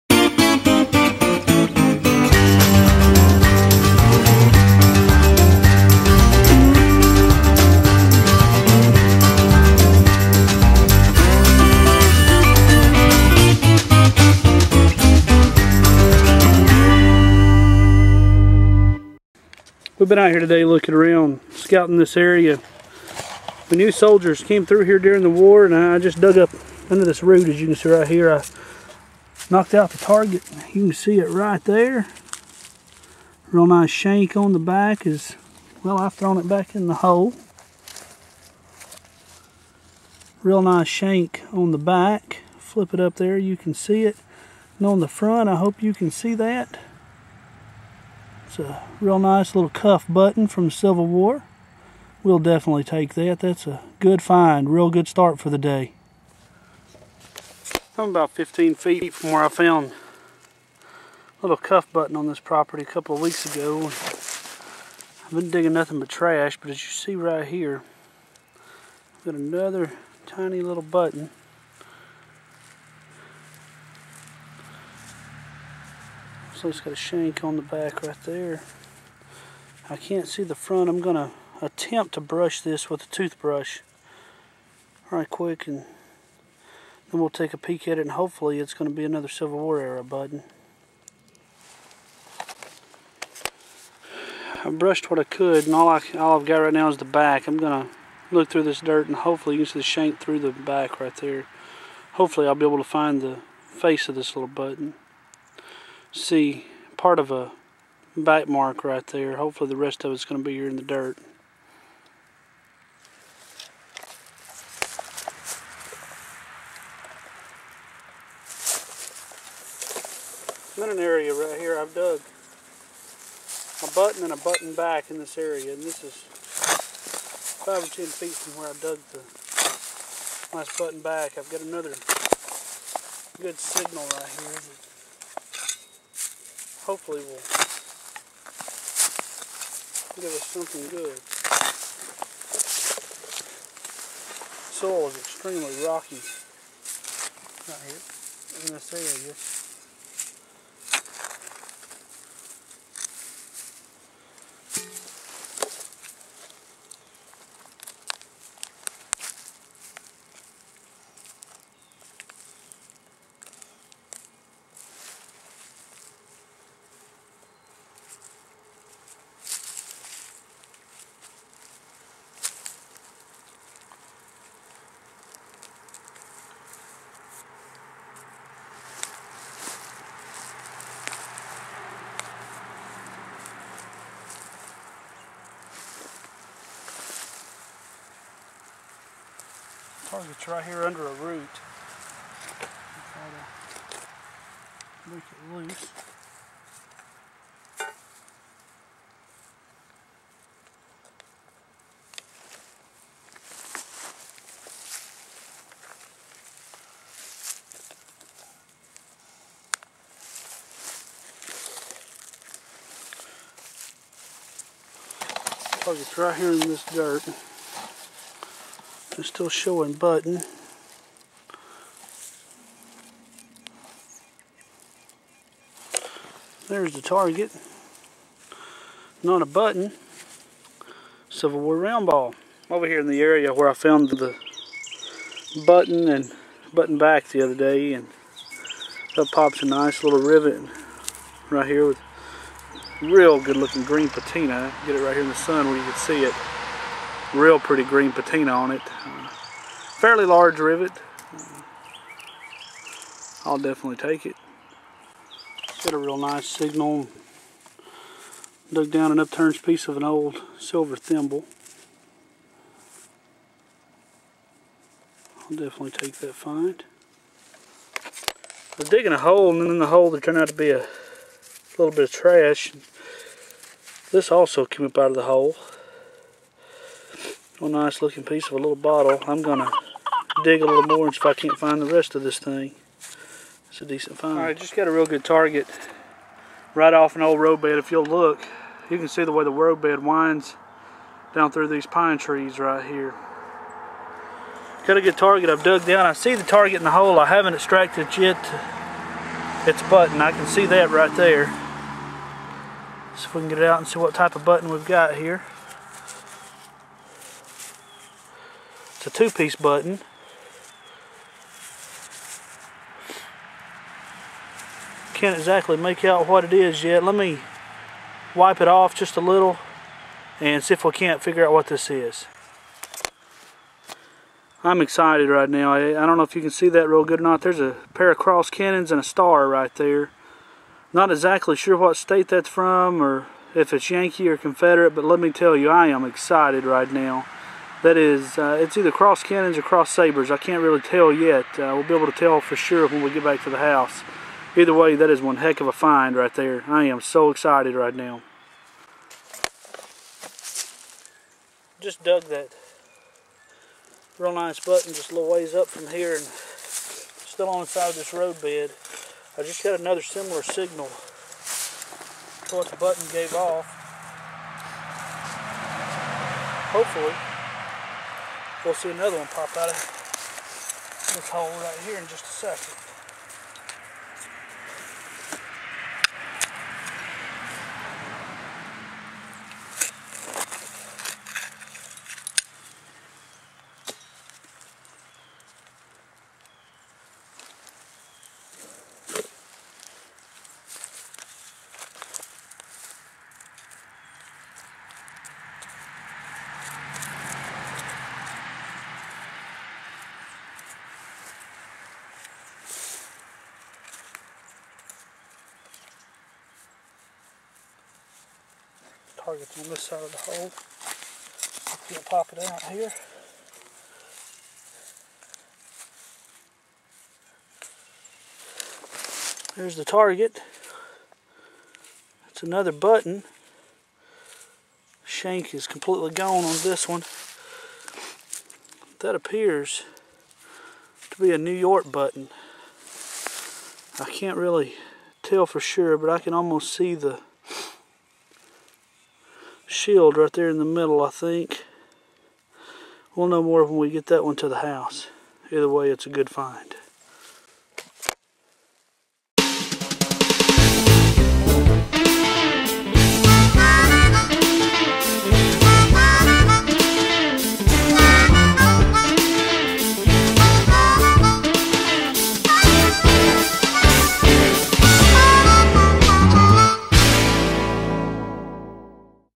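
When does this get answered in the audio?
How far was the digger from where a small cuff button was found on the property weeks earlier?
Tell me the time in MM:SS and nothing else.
00:58.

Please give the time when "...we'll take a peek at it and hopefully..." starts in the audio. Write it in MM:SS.
01:27.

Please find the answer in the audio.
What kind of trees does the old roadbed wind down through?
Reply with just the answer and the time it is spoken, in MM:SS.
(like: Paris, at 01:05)
pine trees, at 04:51.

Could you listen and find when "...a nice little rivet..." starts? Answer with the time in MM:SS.
03:59.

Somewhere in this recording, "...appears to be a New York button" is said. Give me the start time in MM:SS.
07:09.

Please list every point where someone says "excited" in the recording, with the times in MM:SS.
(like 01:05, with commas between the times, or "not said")
05:24, 05:36, 05:47.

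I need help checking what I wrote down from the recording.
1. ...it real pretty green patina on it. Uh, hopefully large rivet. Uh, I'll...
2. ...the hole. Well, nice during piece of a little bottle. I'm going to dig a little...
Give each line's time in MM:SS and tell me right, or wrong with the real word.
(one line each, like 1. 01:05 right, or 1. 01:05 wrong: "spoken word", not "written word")
1. 04:06 wrong: "fairly", not "hopefully"
2. 04:35 wrong: "looking", not "during".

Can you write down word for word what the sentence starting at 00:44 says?
And on the front, I hope you can see that.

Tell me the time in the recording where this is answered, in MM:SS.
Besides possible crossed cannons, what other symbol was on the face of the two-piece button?
05:29.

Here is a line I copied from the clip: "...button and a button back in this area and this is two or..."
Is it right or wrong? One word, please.
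wrong.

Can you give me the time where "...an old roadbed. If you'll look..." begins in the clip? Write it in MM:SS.
04:47.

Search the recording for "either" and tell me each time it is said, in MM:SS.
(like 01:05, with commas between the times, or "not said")
05:38, 05:44, 07:25.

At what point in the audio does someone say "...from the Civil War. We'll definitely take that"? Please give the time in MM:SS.
00:50.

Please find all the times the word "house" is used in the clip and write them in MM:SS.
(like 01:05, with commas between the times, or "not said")
05:43, 07:24.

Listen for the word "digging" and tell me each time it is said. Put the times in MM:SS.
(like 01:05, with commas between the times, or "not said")
01:05, 04:28.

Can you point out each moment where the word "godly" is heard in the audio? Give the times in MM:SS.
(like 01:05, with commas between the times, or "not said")
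not said.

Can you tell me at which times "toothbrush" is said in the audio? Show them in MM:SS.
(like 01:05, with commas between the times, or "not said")
01:23.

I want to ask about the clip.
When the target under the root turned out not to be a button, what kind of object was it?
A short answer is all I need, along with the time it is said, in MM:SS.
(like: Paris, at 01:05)
Civil War round ball, at 03:51.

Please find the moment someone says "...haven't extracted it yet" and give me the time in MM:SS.
04:57.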